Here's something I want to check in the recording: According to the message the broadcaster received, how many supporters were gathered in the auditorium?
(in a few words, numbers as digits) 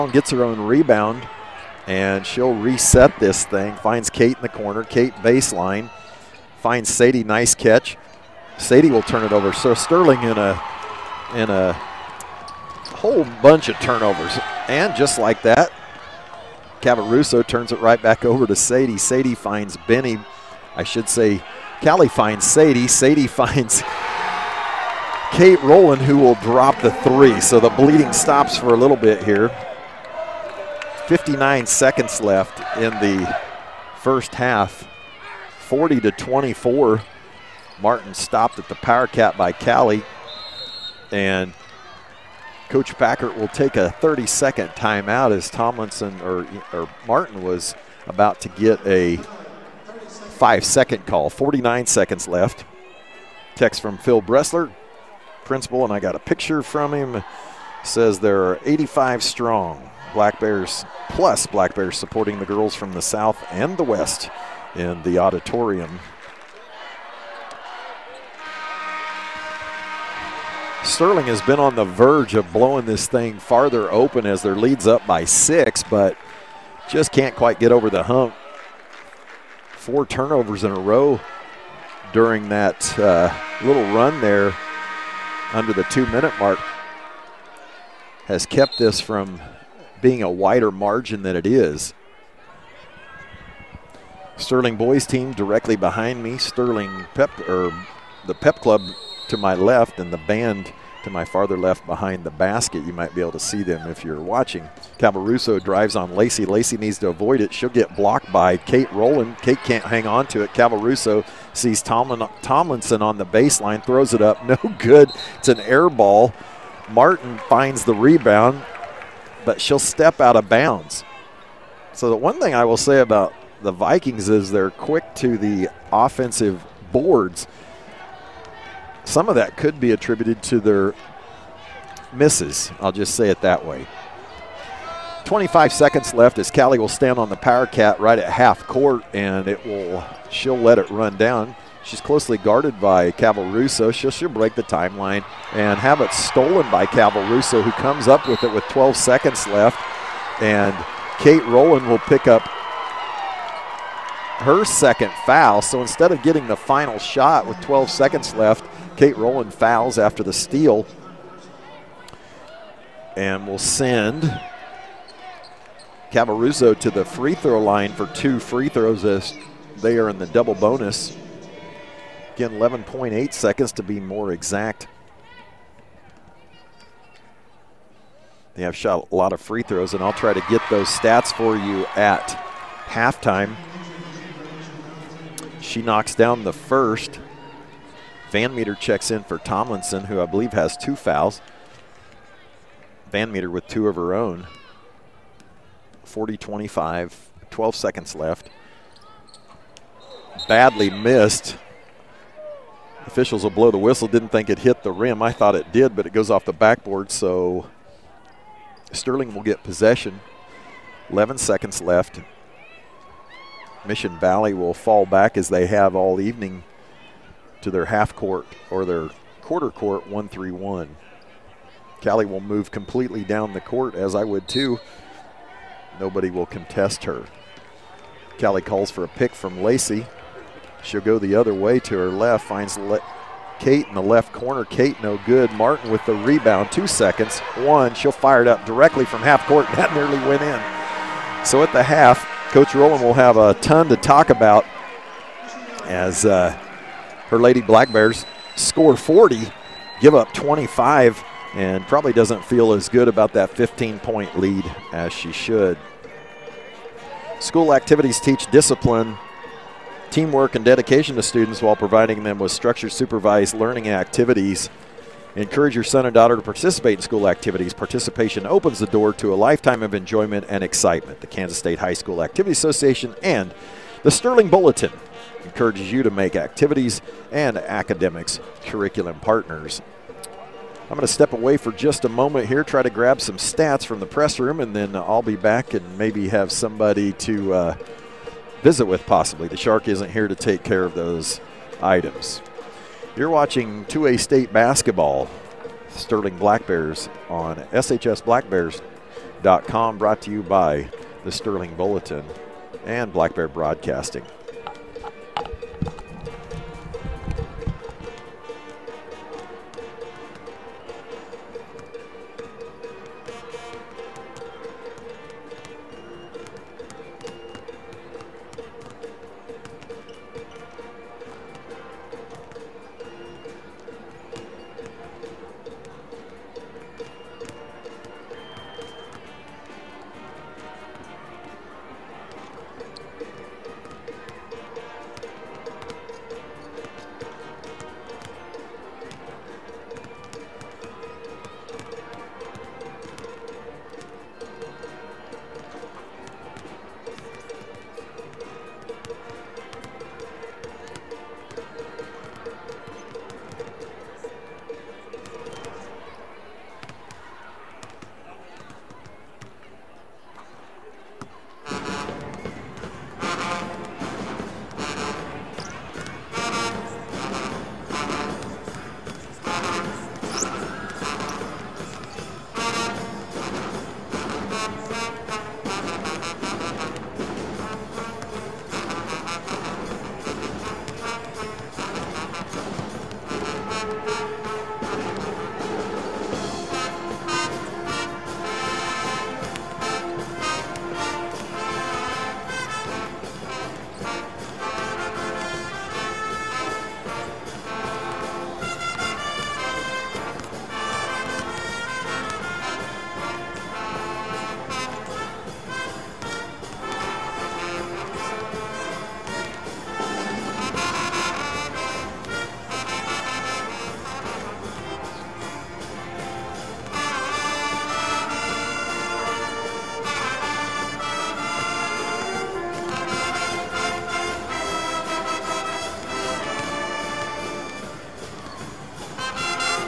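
85.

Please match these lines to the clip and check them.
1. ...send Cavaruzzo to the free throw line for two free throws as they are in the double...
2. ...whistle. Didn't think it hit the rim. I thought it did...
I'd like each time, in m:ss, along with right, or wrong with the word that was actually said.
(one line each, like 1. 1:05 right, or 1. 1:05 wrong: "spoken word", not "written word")
1. 2:43 right
2. 3:23 right.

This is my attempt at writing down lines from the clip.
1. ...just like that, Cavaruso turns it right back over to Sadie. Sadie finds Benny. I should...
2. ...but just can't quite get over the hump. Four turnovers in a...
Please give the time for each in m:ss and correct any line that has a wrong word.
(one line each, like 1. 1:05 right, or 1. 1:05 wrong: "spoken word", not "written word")
1. 0:14 right
2. 1:15 right.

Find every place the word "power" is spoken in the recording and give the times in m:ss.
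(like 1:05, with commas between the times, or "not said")
0:38, 2:17.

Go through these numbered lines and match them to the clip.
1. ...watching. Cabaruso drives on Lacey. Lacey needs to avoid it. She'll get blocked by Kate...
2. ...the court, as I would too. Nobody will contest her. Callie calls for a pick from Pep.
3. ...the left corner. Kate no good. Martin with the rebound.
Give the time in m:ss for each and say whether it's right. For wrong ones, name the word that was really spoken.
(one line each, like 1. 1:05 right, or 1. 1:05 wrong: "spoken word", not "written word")
1. 1:44 right
2. 3:43 wrong: "Lacey", not "Pep"
3. 3:53 right.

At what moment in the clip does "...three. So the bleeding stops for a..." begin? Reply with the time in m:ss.
0:26.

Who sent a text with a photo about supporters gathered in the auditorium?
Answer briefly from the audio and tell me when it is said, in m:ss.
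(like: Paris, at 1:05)
Phil Bressler, at 0:53.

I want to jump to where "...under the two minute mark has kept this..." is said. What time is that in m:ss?
1:25.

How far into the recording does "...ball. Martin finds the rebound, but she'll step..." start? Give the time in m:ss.
1:55.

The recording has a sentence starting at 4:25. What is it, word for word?
Encourage your son and daughter to participate in school activities.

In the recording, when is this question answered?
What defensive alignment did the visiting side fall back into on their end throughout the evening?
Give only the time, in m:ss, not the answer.
3:40.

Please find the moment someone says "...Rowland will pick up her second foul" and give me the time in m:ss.
2:31.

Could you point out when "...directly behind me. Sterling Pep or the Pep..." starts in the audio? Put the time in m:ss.
1:35.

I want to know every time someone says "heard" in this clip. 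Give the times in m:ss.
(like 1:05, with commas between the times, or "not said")
not said.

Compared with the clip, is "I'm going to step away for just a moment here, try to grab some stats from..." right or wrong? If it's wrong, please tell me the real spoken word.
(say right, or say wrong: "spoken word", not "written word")
right.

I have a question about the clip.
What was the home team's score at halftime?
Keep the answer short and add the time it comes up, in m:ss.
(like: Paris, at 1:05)
40, at 4:08.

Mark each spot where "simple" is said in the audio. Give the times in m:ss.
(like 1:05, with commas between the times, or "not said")
not said.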